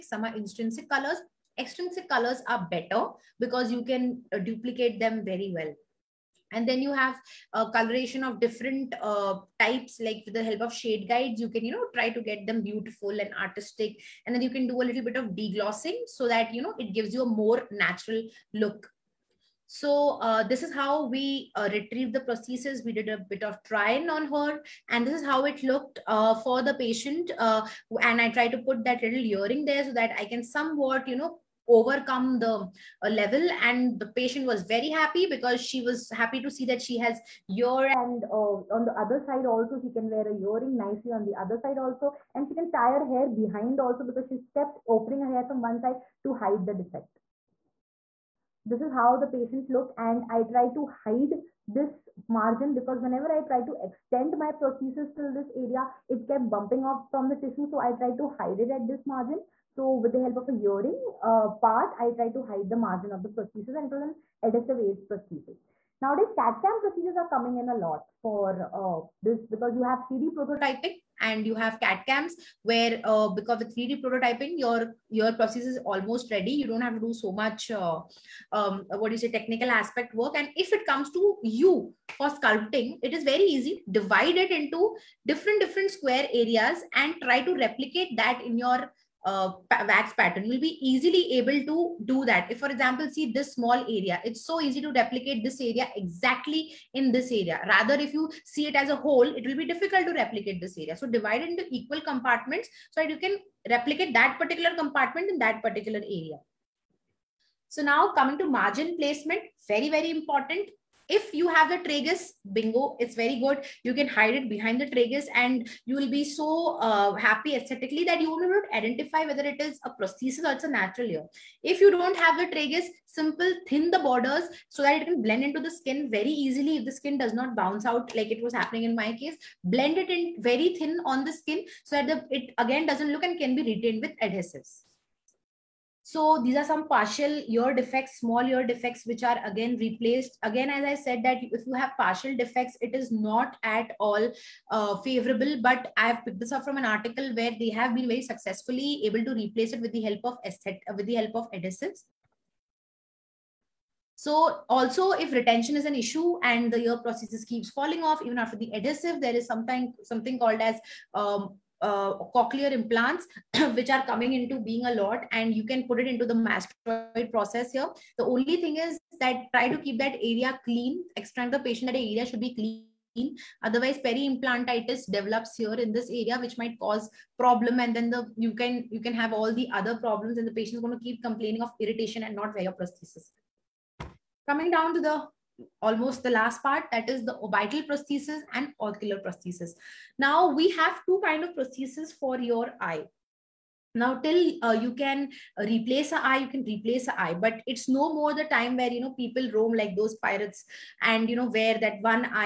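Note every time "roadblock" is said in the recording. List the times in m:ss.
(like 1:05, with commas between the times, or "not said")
not said.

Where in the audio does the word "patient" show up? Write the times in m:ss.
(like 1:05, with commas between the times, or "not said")
0:26, 0:34, 0:49, 2:51, 3:00.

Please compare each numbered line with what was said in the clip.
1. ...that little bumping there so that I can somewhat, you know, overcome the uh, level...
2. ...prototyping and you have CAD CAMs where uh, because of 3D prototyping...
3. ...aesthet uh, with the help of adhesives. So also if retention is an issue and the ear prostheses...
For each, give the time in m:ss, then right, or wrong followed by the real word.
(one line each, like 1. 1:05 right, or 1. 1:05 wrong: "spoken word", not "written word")
1. 0:28 wrong: "earring", not "bumping"
2. 1:10 right
3. 2:30 right.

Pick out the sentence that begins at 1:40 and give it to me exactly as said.
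So divide into equal compartments so that you can replicate that particular compartment in that particular area.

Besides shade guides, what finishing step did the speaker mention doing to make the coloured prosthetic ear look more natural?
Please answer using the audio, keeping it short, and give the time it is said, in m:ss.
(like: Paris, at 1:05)
Deglossing, at 0:15.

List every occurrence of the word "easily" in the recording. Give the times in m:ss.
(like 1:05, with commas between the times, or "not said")
1:30, 2:06.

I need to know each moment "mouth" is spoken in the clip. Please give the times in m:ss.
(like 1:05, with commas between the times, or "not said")
not said.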